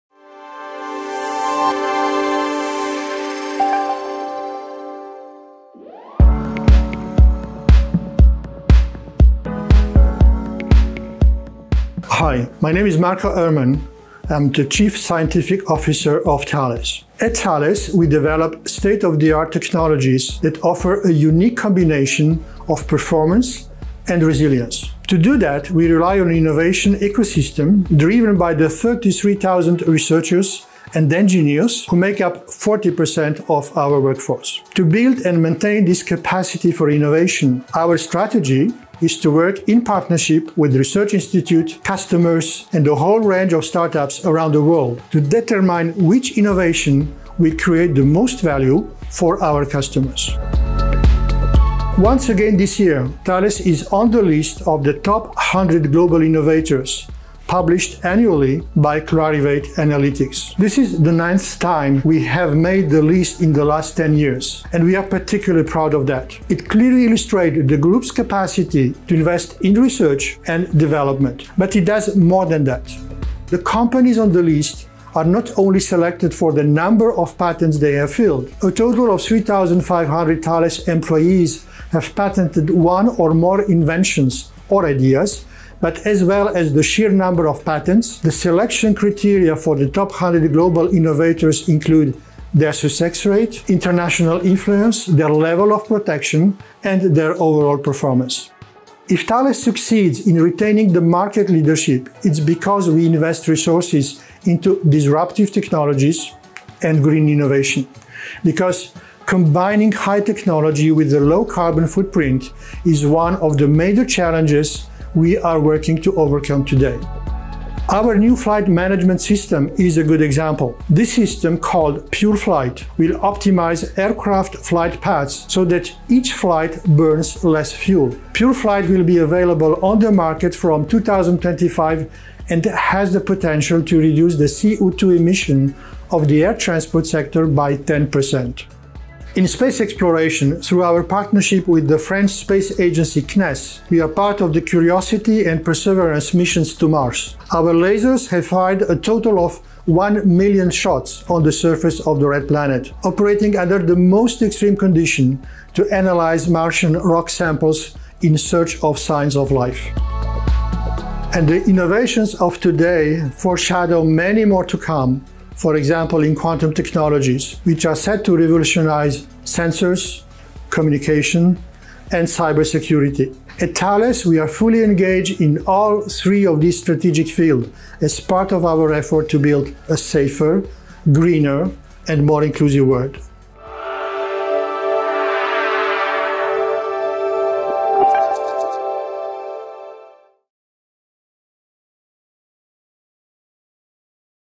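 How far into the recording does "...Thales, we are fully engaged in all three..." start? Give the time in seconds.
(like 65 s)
173 s.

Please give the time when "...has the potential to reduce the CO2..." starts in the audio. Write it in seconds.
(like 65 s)
132 s.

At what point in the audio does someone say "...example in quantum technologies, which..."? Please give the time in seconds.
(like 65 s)
165 s.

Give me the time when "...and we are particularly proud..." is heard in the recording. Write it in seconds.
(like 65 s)
64 s.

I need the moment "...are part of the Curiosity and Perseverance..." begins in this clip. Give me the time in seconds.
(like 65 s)
144 s.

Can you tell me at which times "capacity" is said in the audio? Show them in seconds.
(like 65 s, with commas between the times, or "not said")
36 s, 68 s.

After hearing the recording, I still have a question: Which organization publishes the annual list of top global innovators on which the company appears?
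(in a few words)
Clarivate Analytics.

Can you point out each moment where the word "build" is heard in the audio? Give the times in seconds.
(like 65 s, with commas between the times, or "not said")
34 s, 179 s.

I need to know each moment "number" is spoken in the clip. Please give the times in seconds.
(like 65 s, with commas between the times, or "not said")
76 s, 87 s.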